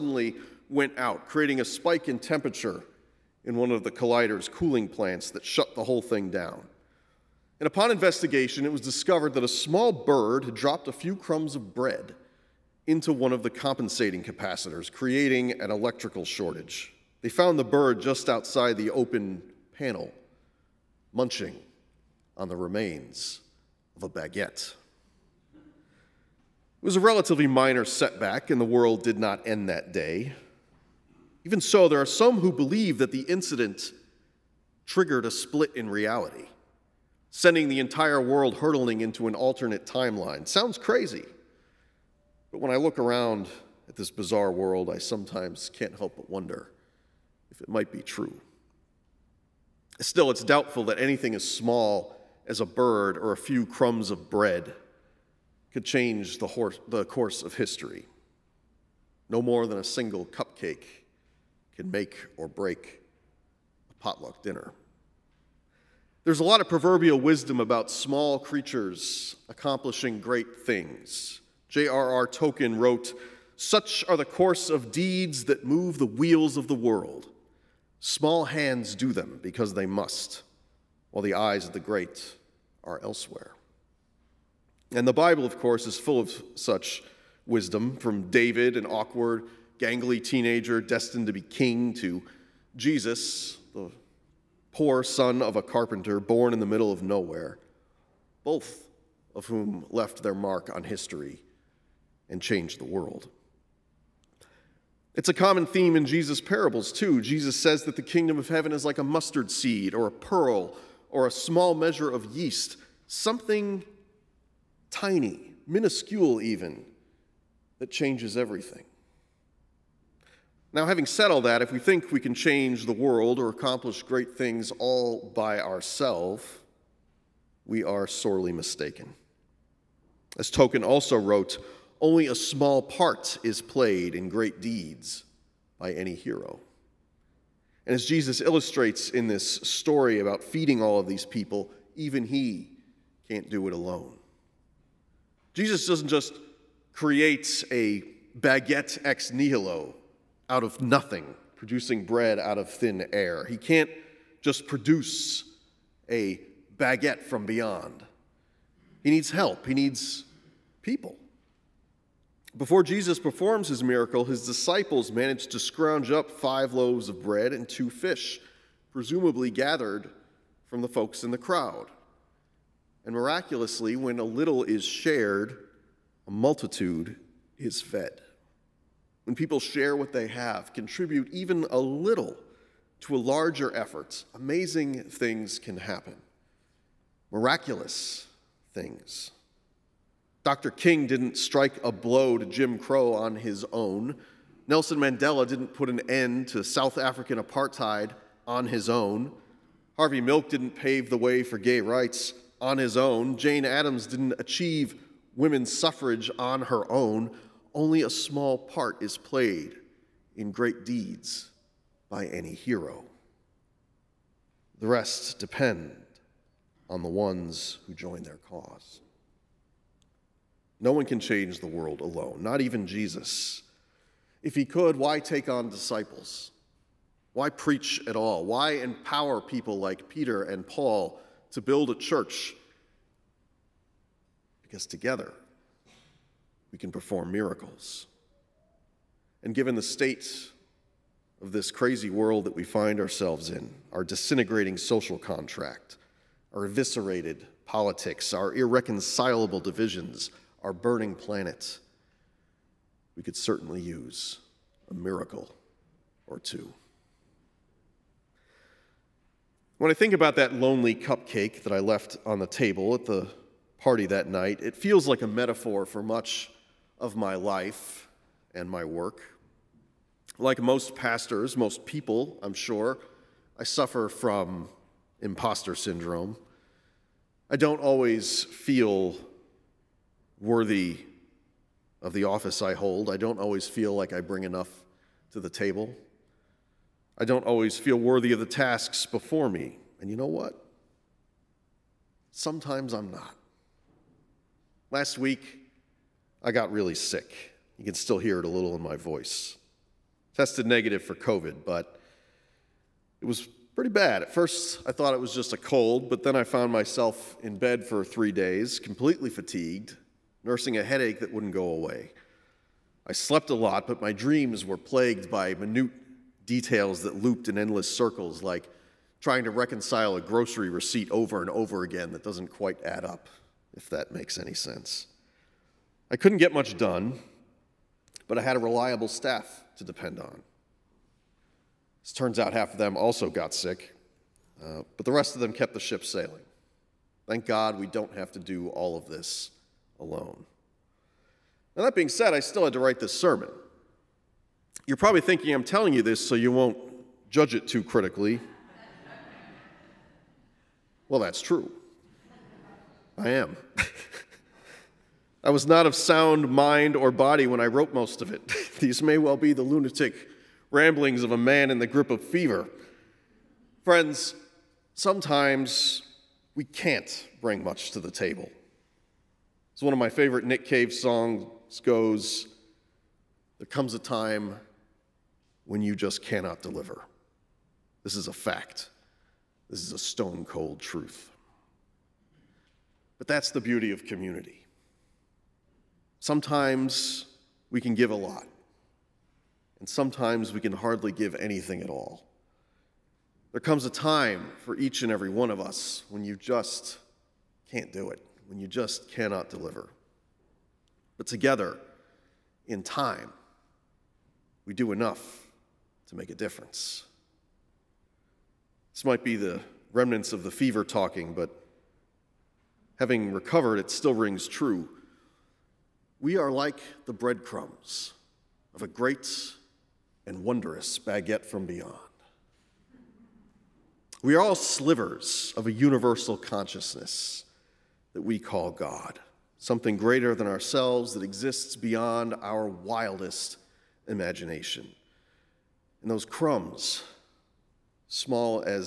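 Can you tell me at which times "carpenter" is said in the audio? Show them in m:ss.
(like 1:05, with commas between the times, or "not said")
1:35.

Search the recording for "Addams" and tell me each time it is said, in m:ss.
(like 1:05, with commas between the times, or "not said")
3:23.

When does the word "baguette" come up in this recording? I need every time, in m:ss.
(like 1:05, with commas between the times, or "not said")
0:24, 2:28, 2:36, 7:00.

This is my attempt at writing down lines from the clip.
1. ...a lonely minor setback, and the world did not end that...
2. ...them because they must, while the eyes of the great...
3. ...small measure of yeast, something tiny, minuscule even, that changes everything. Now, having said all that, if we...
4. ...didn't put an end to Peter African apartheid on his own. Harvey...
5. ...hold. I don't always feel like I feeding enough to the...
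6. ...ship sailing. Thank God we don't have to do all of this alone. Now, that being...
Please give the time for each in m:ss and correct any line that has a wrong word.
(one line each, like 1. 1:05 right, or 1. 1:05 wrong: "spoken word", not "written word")
1. 0:26 wrong: "relatively", not "lonely"
2. 1:19 right
3. 1:51 right
4. 3:15 wrong: "South", not "Peter"
5. 4:42 wrong: "bring", not "feeding"
6. 5:35 right.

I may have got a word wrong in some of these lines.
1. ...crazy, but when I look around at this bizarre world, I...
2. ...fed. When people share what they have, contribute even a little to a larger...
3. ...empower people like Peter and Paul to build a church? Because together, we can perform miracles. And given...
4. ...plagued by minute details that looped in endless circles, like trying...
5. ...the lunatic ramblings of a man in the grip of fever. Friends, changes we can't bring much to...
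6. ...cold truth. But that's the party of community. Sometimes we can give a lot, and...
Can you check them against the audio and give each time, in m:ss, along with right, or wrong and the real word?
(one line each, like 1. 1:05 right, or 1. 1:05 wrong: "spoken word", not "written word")
1. 0:40 right
2. 2:57 right
3. 3:48 right
4. 5:14 right
5. 5:59 wrong: "sometimes", not "changes"
6. 6:20 wrong: "beauty", not "party".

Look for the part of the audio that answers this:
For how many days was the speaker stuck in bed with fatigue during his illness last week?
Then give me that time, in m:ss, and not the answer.
5:08.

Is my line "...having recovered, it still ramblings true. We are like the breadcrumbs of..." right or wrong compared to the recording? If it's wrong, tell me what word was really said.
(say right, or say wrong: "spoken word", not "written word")
wrong: "rings", not "ramblings".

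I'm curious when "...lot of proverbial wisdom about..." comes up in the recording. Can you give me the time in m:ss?
1:06.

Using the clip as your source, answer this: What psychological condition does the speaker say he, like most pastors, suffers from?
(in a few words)
imposter syndrome.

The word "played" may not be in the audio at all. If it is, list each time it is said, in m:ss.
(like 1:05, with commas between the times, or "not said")
2:13, 3:29.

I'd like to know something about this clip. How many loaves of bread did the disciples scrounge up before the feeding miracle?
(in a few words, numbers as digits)
5.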